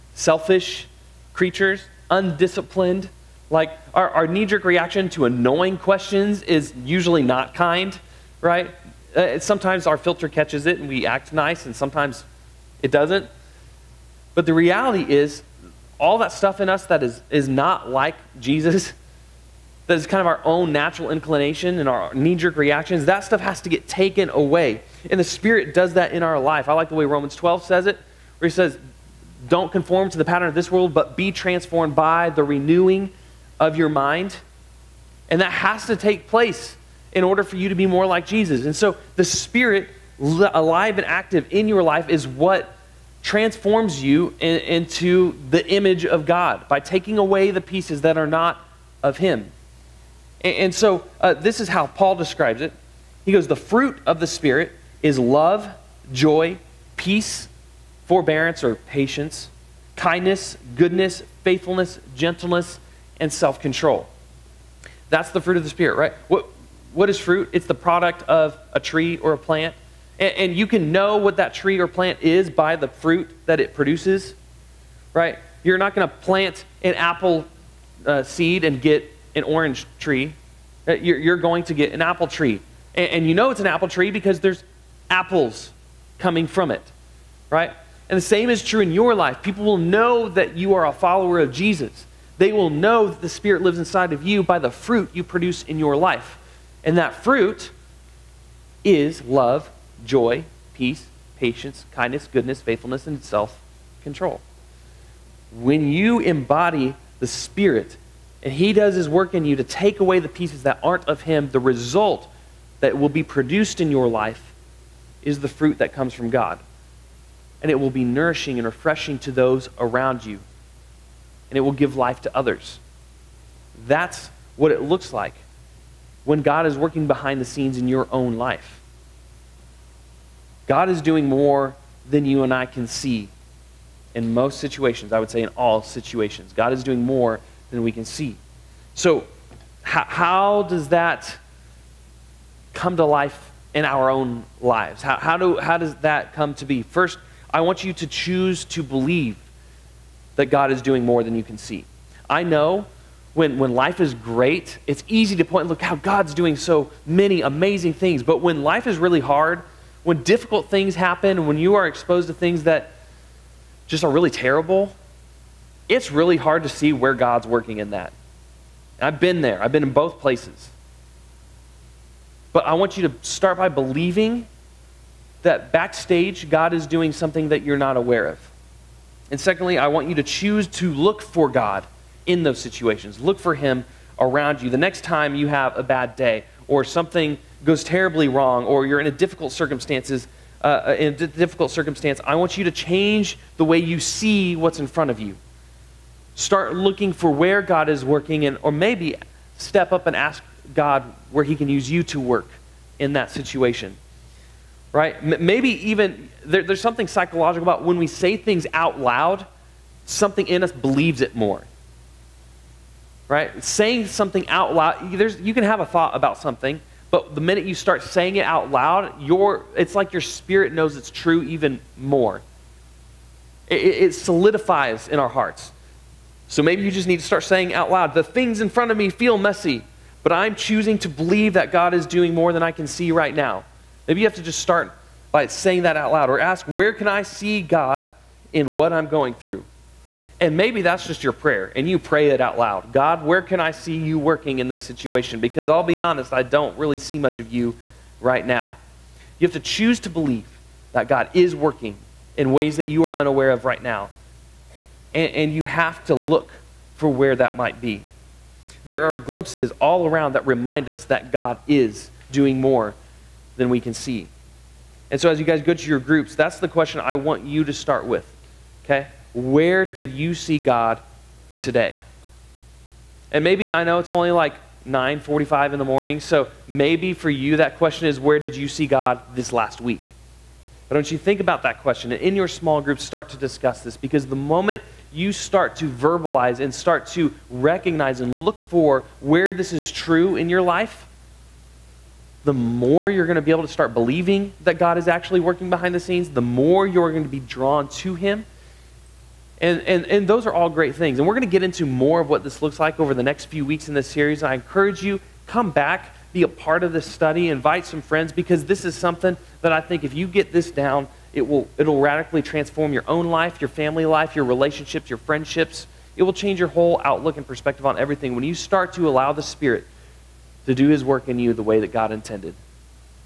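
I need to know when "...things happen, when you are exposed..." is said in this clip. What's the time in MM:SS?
02:40.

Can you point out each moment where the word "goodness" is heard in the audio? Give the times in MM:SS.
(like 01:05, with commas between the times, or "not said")
01:00, 01:42.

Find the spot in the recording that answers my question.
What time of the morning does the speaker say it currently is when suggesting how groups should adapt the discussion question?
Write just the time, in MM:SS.
04:34.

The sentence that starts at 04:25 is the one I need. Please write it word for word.
And so, as you guys go to your groups, that's the question I want you to start with, okay?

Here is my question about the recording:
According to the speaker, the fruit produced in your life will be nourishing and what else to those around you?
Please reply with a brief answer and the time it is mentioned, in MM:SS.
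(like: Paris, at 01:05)
refreshing, at 01:58.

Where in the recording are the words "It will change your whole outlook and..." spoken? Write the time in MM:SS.
05:16.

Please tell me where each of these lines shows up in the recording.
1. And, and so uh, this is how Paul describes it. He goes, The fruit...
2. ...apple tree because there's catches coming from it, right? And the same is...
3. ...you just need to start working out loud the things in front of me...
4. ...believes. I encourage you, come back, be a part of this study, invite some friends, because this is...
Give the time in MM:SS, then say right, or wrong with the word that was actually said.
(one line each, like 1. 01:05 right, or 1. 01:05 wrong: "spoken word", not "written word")
1. 00:50 right
2. 01:23 wrong: "apples", not "catches"
3. 03:46 wrong: "saying", not "working"
4. 05:04 wrong: "series", not "believes".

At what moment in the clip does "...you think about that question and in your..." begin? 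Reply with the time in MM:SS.
04:41.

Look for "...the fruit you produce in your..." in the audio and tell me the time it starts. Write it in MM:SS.
01:34.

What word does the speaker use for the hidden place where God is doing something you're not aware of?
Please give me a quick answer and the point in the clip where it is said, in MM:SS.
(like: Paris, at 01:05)
backstage, at 02:55.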